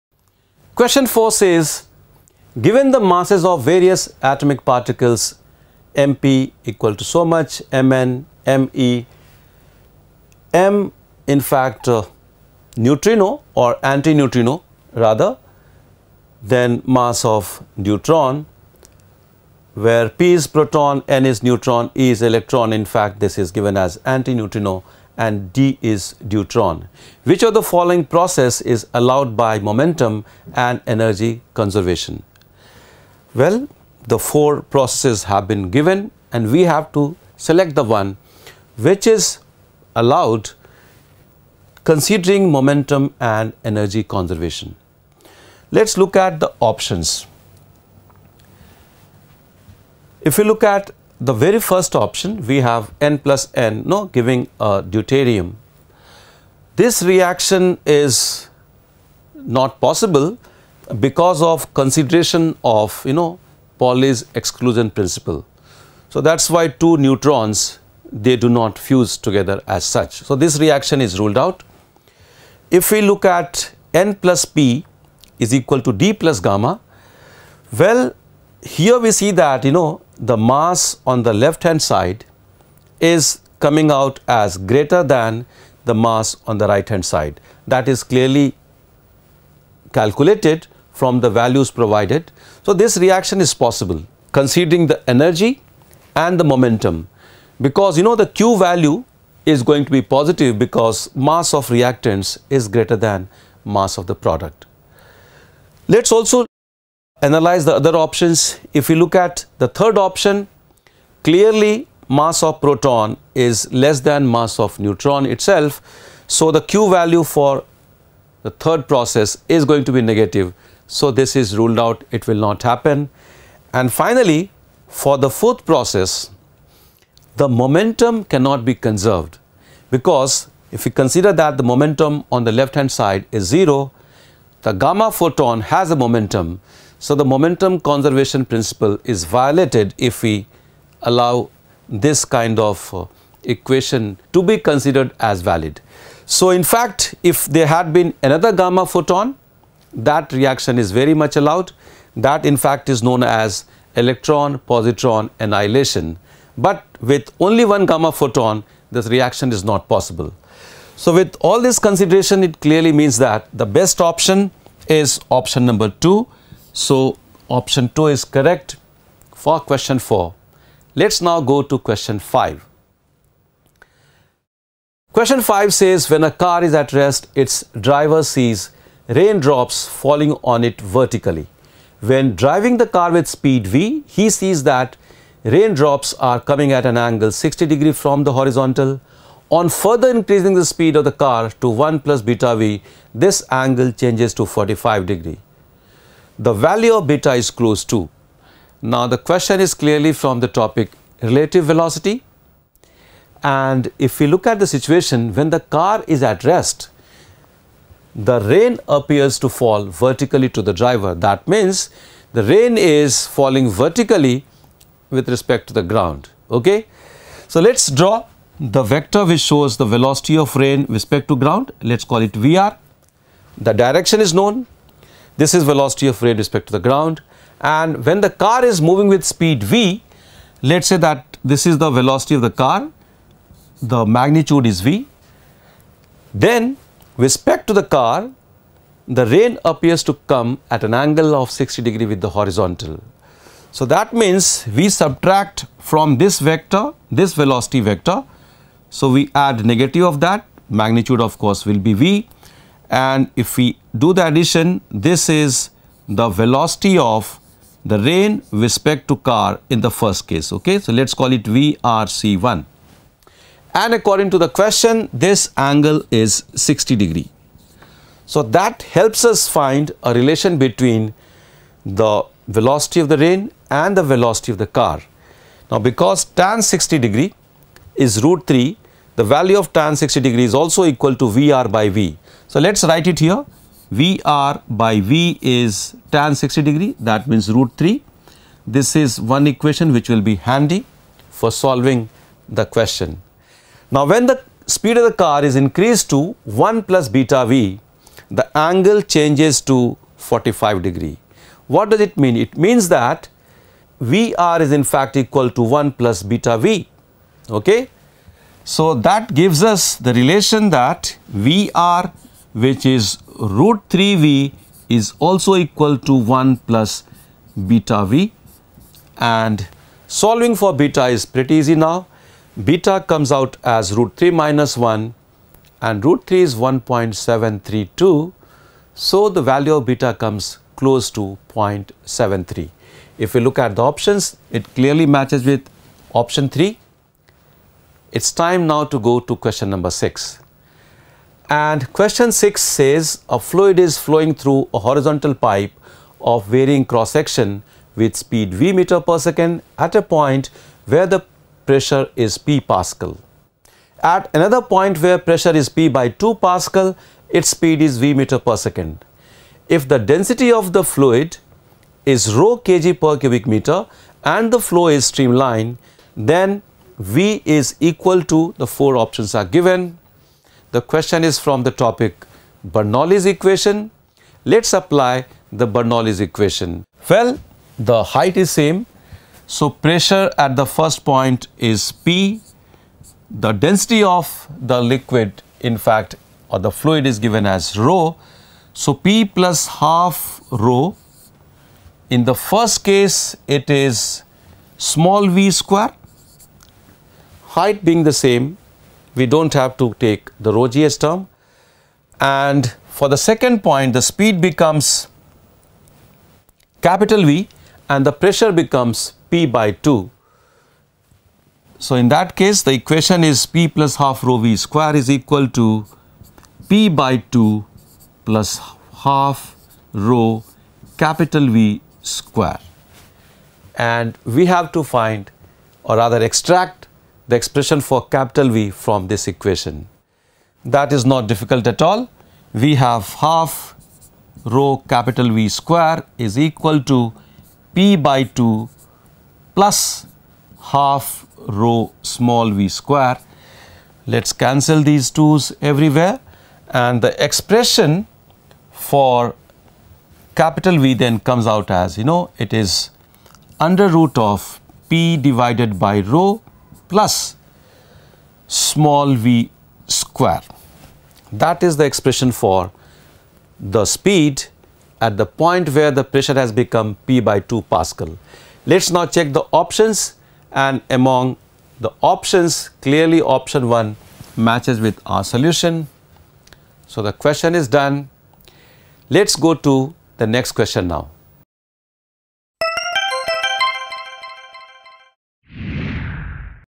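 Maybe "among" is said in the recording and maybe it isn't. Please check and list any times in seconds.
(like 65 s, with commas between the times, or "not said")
470 s.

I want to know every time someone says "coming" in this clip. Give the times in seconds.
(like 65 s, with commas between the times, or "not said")
83 s, 186 s.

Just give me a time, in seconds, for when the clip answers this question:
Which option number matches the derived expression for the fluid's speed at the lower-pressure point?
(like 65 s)
473 s.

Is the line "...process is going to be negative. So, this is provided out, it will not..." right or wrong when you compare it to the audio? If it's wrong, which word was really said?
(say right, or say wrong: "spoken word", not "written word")
wrong: "ruled", not "provided".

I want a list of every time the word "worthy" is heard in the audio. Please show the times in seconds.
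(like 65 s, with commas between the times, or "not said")
not said.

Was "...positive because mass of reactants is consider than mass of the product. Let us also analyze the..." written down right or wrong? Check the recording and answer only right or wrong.
wrong.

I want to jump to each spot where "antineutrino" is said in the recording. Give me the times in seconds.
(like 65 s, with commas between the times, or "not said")
13 s, 23 s.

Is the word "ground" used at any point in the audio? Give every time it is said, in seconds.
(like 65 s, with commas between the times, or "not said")
215 s, 221 s, 226 s.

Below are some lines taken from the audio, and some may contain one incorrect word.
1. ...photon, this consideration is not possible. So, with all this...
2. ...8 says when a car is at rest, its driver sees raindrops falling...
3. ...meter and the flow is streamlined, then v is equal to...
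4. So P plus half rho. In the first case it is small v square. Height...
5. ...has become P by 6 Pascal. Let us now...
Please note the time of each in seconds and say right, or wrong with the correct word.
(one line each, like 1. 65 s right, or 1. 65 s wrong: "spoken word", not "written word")
1. 158 s wrong: "reaction", not "consideration"
2. 175 s wrong: "5", not "8"
3. 363 s right
4. 388 s right
5. 466 s wrong: "2", not "6".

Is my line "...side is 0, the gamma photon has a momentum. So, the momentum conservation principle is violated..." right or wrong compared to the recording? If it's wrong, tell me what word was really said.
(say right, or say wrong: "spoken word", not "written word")
right.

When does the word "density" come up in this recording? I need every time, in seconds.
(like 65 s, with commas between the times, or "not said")
359 s, 383 s.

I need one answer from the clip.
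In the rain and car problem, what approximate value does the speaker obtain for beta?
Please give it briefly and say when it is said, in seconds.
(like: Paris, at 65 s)
0.73, at 331 s.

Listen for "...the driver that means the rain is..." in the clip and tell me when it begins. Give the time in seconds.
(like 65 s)
210 s.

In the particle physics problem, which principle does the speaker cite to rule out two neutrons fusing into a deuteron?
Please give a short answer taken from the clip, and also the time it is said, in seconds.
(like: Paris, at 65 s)
Pauli's exclusion principle, at 63 s.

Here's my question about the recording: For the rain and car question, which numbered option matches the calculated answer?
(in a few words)
option 3.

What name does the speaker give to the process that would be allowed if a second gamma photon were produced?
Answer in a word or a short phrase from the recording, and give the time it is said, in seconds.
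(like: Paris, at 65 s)
electron positron annihilation, at 153 s.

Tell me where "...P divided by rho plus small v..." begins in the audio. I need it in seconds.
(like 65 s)
454 s.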